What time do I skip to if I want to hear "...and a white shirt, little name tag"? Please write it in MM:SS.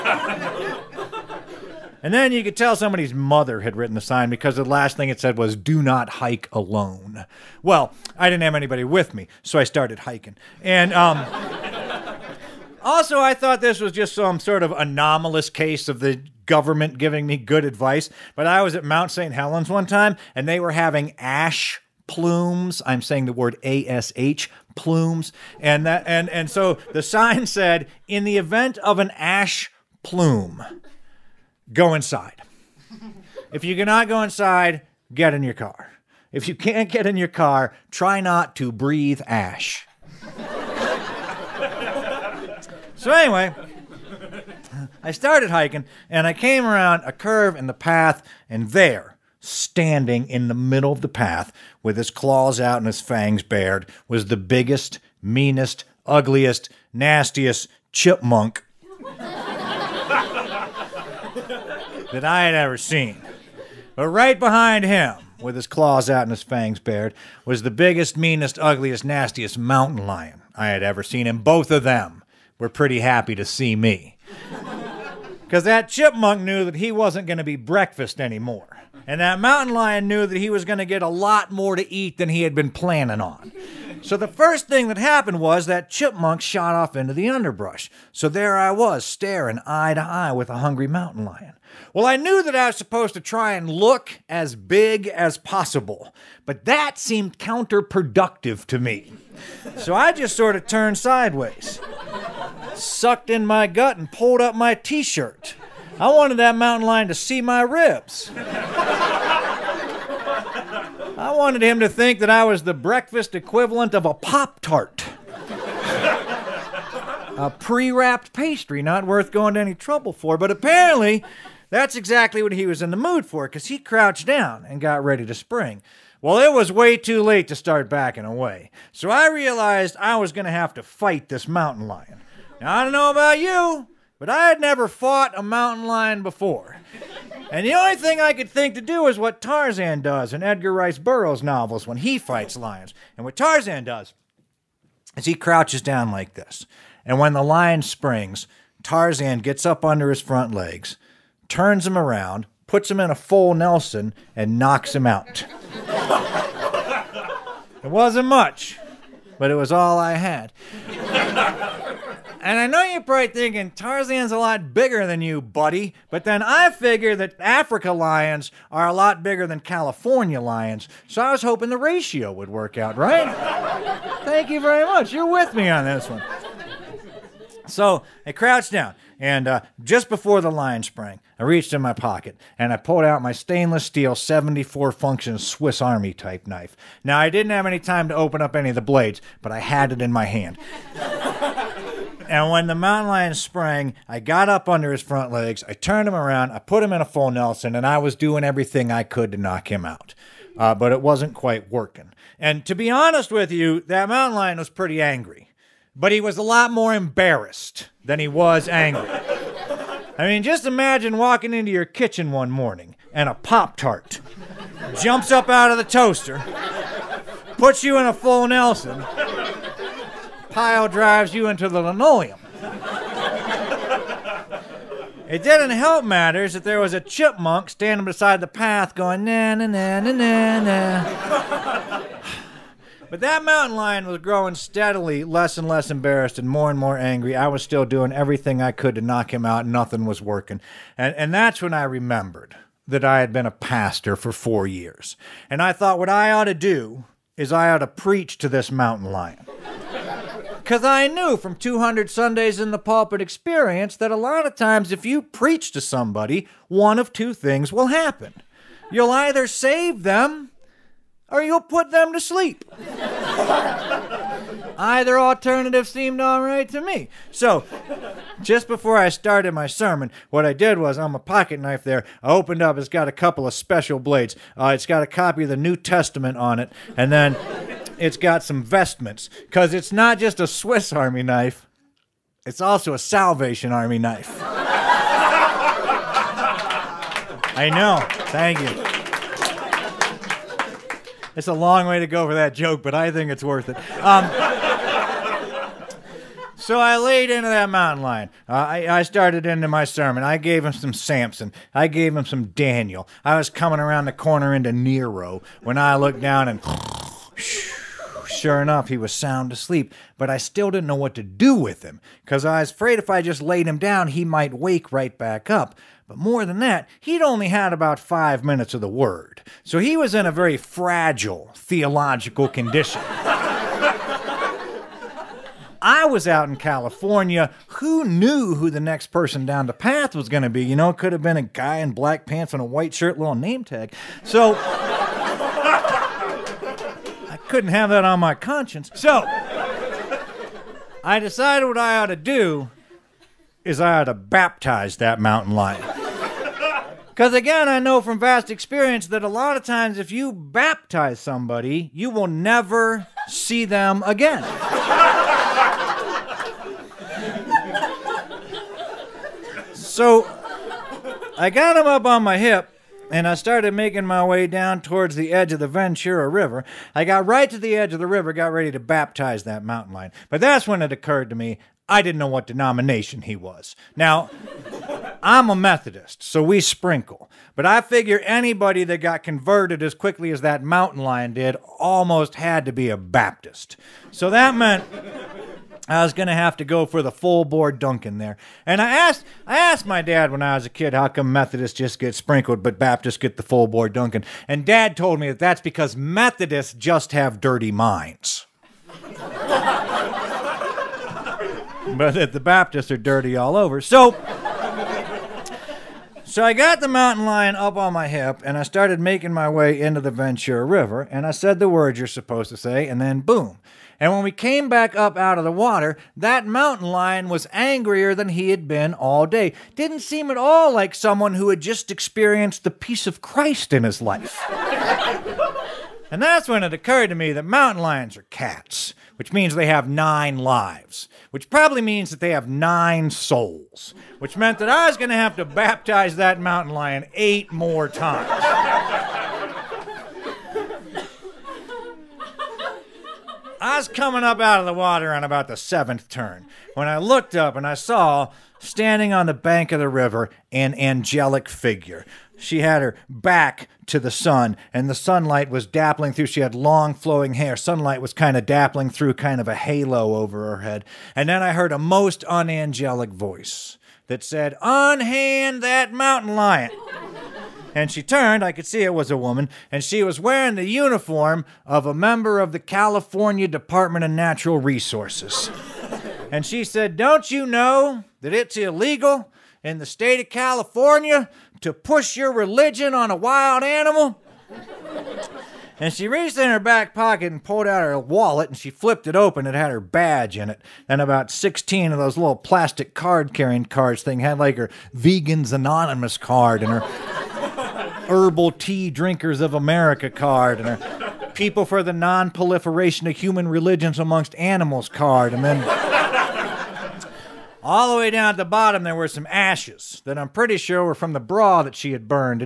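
05:32.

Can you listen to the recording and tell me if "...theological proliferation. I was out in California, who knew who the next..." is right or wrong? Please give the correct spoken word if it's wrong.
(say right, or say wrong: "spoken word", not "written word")
wrong: "condition", not "proliferation".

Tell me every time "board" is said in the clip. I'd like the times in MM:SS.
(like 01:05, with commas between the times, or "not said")
06:27, 06:33.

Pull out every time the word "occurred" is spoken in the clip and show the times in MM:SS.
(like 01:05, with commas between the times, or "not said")
06:10, 07:06.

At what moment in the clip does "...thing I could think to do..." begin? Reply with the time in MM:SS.
02:17.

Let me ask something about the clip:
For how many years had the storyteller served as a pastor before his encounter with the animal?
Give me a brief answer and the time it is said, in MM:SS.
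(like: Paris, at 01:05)
4, at 04:04.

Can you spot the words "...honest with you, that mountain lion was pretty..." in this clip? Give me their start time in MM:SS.
03:22.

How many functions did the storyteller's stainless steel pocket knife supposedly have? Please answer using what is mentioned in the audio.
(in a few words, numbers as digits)
74.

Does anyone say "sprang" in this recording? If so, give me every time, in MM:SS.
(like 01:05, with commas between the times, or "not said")
03:00, 03:13.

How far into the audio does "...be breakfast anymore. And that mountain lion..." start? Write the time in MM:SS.
01:17.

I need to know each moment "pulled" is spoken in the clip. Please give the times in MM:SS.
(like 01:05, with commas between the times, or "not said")
01:44, 03:02, 08:07.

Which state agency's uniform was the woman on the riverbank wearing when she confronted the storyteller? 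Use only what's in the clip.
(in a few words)
California Department of Natural Resources.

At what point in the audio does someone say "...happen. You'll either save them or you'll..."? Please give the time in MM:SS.
04:17.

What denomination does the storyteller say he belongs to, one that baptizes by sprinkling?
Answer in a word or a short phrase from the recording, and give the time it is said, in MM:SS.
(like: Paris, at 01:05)
Methodist, at 06:15.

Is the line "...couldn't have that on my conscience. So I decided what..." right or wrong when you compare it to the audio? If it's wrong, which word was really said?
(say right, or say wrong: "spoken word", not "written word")
right.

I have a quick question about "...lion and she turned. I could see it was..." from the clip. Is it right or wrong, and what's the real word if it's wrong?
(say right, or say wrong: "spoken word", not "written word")
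right.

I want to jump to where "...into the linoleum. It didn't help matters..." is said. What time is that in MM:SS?
03:41.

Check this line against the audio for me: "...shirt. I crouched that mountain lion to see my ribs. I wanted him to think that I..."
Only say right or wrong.
wrong.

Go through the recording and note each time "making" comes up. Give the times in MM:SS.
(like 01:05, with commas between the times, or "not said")
06:03, 06:48.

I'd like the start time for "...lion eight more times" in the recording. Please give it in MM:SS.
07:16.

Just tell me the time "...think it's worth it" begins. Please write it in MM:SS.
04:53.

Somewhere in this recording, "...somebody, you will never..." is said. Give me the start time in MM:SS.
05:51.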